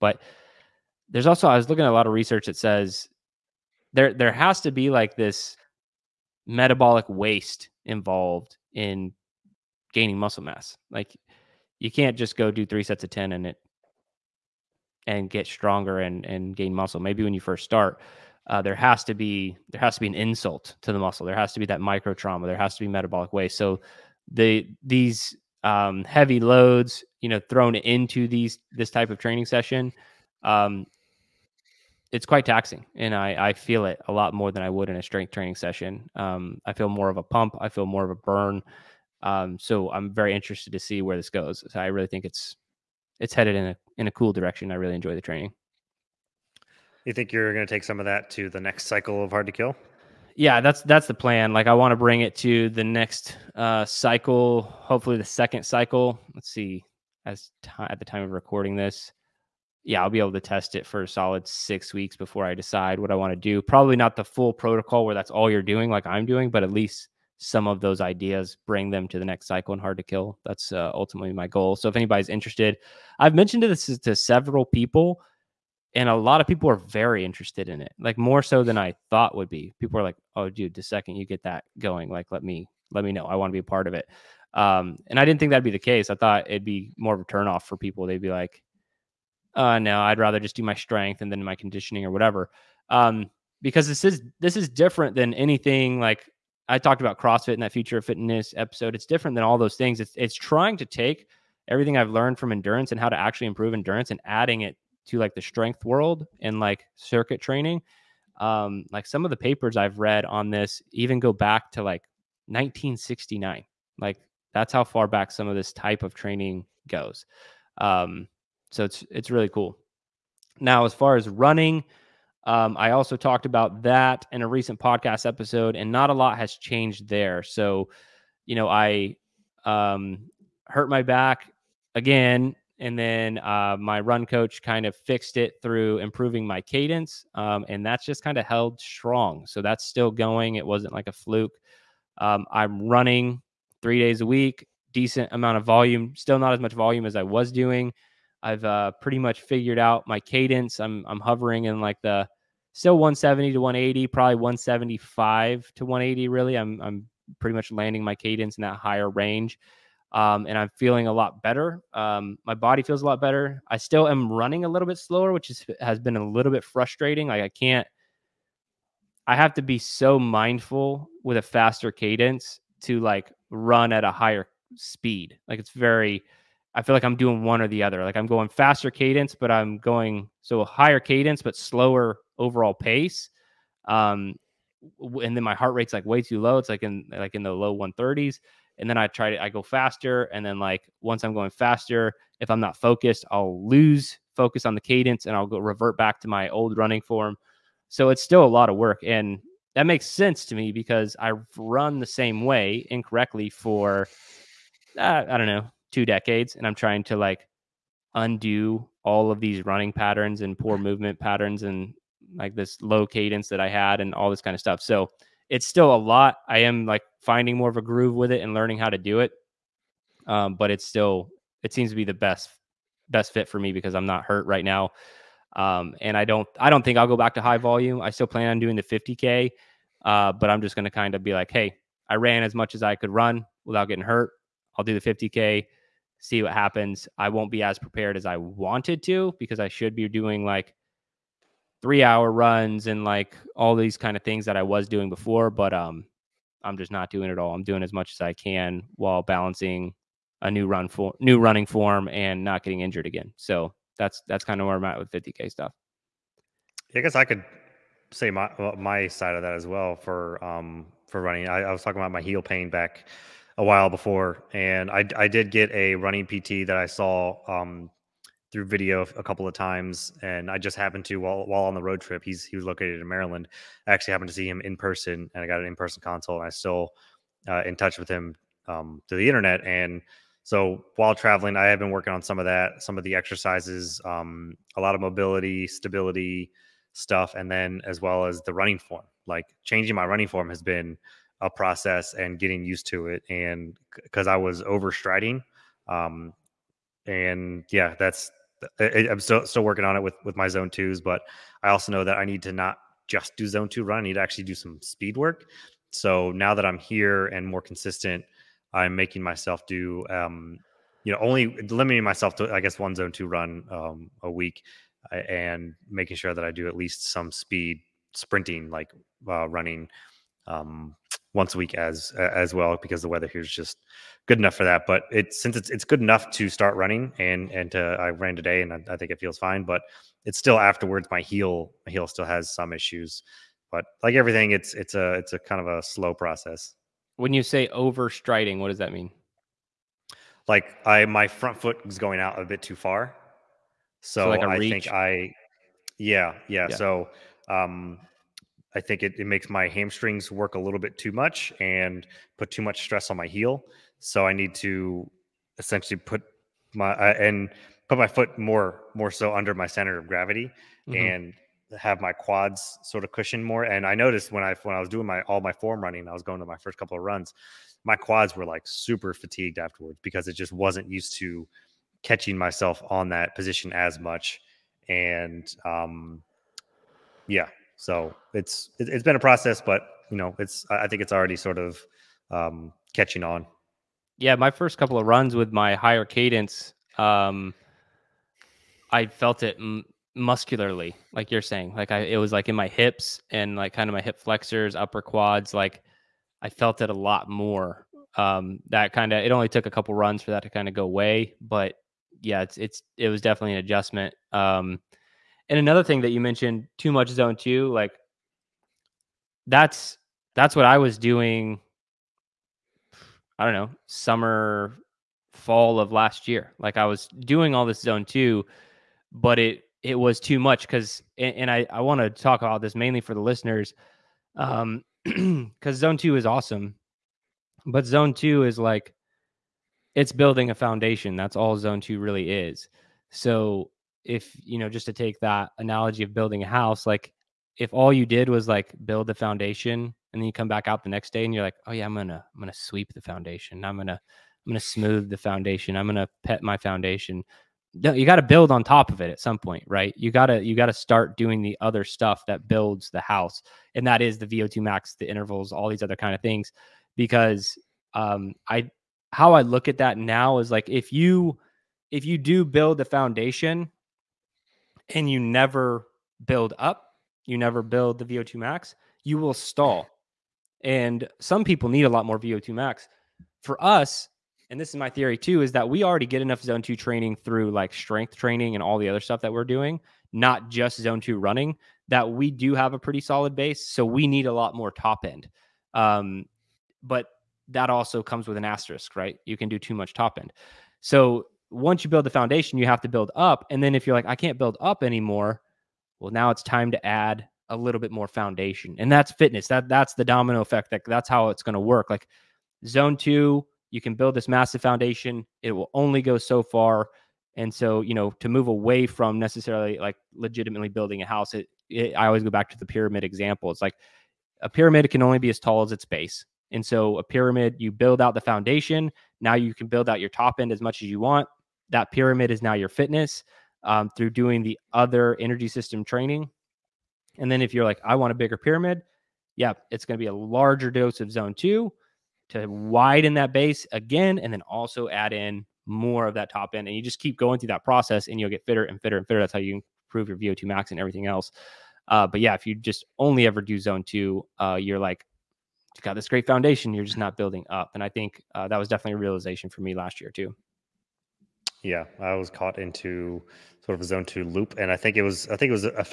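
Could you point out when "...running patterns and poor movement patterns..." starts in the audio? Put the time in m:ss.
3:29.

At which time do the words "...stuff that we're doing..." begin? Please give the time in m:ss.
7:58.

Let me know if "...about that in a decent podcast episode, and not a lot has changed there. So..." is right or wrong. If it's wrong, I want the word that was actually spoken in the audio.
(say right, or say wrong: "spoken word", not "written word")
wrong: "recent", not "decent".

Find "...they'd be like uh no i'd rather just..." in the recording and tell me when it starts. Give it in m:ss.
1:28.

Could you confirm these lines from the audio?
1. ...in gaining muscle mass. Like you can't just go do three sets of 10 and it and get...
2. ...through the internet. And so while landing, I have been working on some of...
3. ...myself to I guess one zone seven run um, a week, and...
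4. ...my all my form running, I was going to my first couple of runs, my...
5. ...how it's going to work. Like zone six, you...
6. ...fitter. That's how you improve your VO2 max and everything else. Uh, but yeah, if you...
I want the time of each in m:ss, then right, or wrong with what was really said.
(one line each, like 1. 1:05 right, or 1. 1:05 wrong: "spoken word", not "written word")
1. 0:08 right
2. 4:39 wrong: "traveling", not "landing"
3. 5:12 wrong: "two", not "seven"
4. 6:05 right
5. 8:21 wrong: "two", not "six"
6. 8:59 right.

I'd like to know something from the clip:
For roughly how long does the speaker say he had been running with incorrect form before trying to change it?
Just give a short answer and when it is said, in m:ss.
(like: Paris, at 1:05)
two decades, at 3:25.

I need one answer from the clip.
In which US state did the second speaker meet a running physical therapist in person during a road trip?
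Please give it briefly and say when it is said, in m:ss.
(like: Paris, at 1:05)
Maryland, at 4:33.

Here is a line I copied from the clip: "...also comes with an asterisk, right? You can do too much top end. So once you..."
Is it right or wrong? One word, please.
right.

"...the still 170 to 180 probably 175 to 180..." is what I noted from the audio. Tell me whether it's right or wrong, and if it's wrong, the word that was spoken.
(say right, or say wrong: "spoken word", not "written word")
right.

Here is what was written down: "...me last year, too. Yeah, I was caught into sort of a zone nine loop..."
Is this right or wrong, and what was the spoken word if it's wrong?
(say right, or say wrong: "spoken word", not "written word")
wrong: "two", not "nine".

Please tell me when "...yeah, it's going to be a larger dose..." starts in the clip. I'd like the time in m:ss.
8:49.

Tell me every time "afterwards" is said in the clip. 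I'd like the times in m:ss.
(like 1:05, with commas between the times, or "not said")
5:30, 6:09.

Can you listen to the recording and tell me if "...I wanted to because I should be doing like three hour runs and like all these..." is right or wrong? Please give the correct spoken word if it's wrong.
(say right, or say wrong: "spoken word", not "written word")
right.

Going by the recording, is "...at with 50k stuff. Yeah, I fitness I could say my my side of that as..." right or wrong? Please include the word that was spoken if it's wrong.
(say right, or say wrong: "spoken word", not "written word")
wrong: "guess", not "fitness".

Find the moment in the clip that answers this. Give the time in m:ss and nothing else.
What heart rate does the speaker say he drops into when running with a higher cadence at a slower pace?
3:07.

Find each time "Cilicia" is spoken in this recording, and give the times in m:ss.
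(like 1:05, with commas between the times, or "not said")
not said.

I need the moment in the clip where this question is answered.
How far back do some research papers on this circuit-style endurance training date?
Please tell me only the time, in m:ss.
1:52.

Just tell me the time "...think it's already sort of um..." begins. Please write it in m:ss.
6:20.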